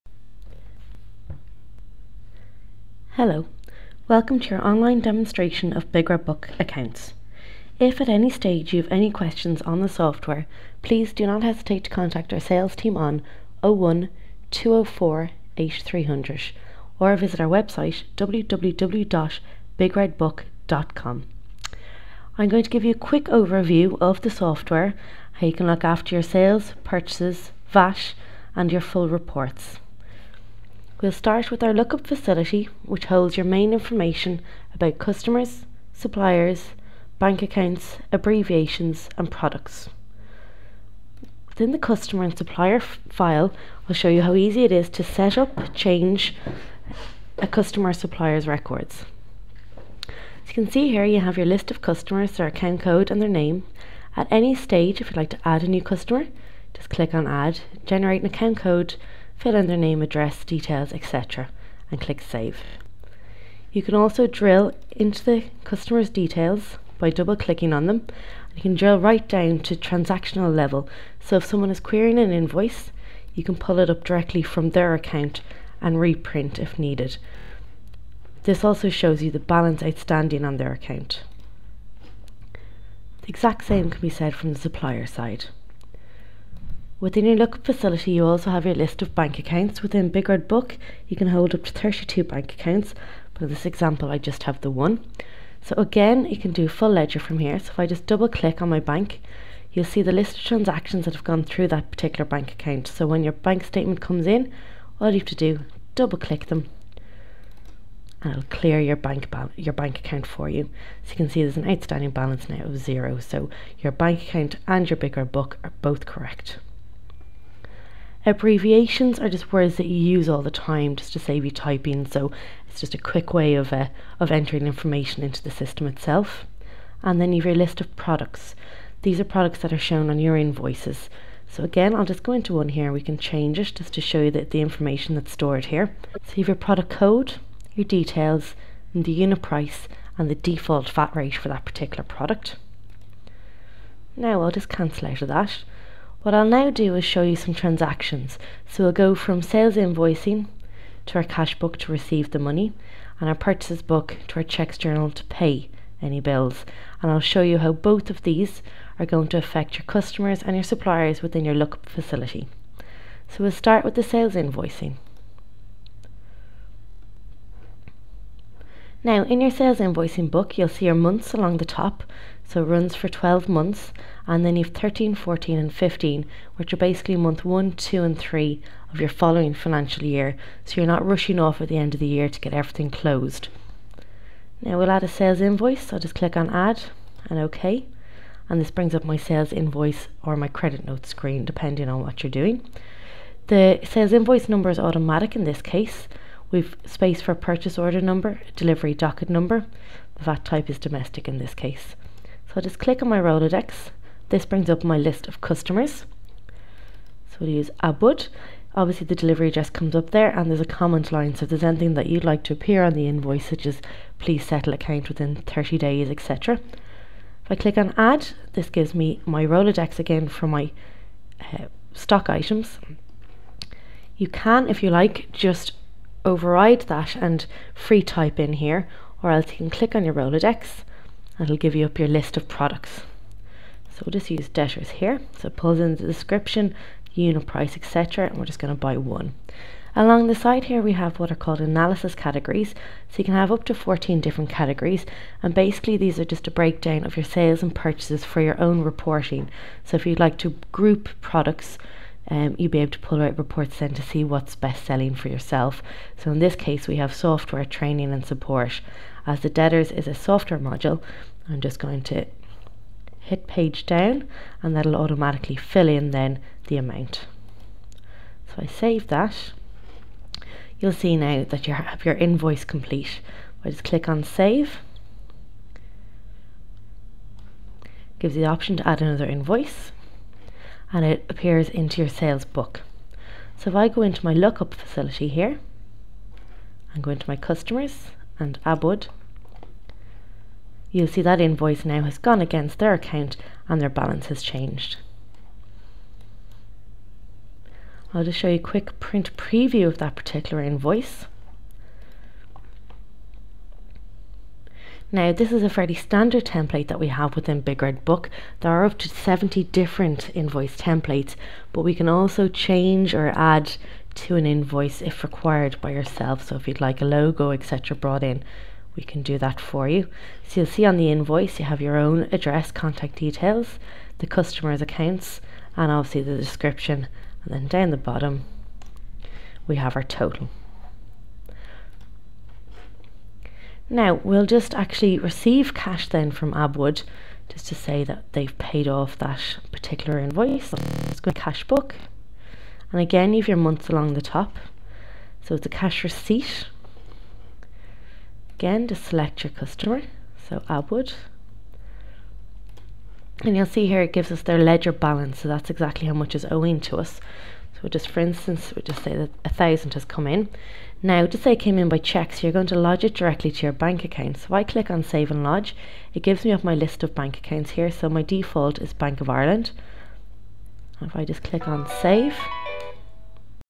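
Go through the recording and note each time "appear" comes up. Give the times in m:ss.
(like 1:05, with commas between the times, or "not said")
3:32, 4:41.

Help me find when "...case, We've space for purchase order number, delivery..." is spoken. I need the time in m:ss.
3:15.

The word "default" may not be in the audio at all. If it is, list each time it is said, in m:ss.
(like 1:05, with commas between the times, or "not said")
2:20, 6:08.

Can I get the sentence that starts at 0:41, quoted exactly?
Within the customer and supplier file, I'll show you how easy it is to set up, change a customer supplier's records.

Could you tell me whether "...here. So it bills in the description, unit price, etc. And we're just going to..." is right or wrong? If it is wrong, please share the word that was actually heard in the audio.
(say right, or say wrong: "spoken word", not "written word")
wrong: "pulls", not "bills".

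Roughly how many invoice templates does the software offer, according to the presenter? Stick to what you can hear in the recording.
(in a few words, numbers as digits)
70.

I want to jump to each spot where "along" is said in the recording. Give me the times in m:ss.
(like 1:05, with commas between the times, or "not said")
2:51, 3:59, 5:43.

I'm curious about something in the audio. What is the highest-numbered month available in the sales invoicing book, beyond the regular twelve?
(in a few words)
15.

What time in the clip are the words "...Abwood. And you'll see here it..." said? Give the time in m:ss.
5:50.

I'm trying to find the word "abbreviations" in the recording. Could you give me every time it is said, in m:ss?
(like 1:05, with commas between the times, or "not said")
0:38, 1:58.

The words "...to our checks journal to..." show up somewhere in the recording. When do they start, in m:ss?
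2:34.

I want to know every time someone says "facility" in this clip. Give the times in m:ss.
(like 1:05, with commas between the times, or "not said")
0:32, 1:27, 2:41, 4:44.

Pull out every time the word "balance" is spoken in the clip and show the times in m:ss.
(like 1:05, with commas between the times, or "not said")
1:19, 1:52, 4:53, 5:54.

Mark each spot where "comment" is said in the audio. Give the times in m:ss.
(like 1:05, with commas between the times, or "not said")
3:30.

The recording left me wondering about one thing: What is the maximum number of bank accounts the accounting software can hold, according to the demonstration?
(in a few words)
32.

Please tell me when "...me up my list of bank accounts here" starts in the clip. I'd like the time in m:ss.
6:06.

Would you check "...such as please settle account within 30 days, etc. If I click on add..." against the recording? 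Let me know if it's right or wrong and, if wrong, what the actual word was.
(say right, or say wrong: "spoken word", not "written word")
right.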